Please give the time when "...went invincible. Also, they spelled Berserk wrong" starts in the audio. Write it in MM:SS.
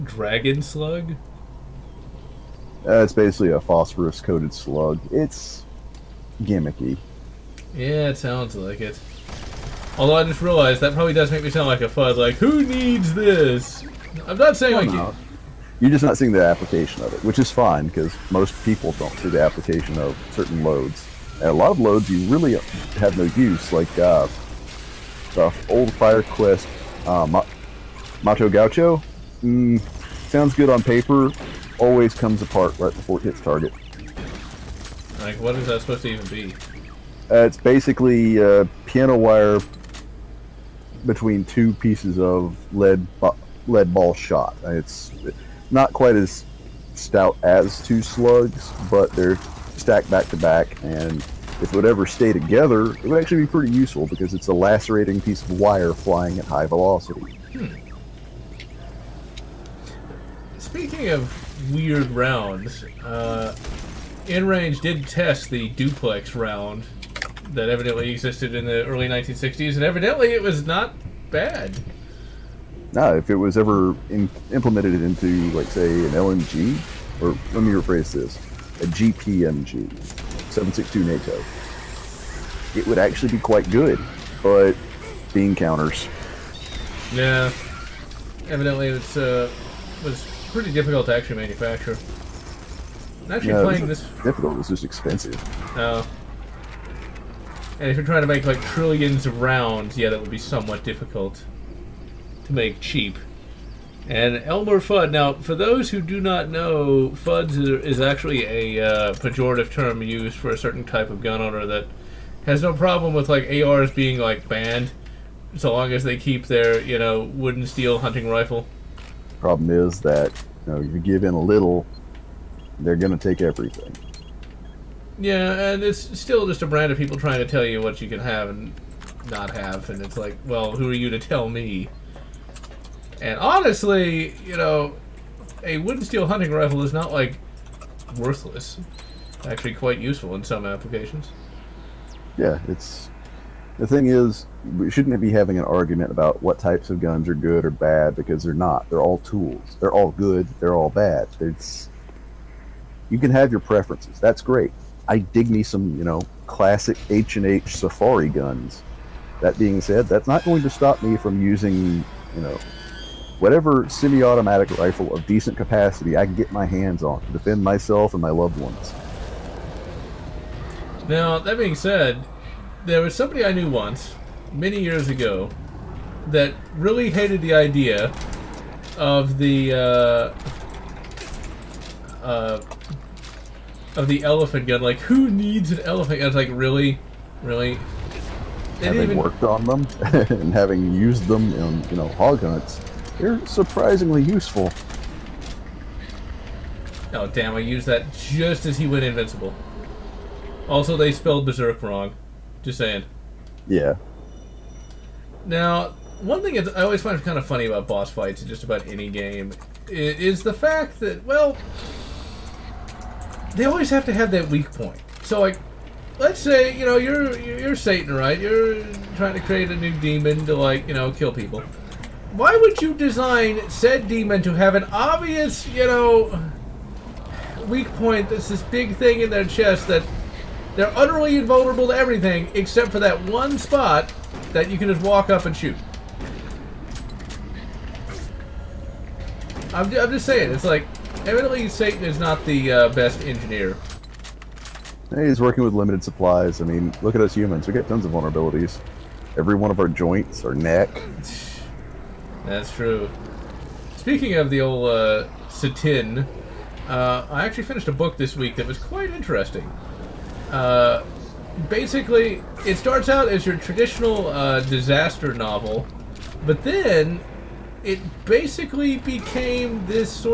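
03:18.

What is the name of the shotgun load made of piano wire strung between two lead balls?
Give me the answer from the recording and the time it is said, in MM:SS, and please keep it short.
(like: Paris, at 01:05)
Ma Gaucho, at 00:27.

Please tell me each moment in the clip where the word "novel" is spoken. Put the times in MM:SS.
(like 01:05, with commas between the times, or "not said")
04:25.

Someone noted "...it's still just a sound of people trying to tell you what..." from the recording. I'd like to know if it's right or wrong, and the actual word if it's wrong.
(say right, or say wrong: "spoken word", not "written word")
wrong: "brand", not "sound".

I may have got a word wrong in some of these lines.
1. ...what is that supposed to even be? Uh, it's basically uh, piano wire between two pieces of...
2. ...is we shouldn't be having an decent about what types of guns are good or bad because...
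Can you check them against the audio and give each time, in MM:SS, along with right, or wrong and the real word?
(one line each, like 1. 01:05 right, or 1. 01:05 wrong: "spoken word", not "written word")
1. 00:35 right
2. 02:24 wrong: "argument", not "decent".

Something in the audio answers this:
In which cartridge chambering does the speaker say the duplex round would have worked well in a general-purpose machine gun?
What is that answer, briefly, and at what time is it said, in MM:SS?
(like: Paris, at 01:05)
7.62 NATO, at 01:20.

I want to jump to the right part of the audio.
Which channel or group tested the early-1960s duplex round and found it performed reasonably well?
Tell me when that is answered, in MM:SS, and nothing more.
01:04.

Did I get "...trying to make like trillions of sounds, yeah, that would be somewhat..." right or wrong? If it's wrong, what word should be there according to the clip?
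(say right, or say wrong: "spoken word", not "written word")
wrong: "rounds", not "sounds".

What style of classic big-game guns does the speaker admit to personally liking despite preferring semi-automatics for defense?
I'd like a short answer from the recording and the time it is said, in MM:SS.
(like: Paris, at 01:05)
H and H Safari guns, at 02:37.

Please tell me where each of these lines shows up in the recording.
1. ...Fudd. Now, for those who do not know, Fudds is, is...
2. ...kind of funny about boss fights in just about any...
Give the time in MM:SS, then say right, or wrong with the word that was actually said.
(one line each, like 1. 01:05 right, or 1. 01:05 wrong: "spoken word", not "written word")
1. 01:44 right
2. 03:27 right.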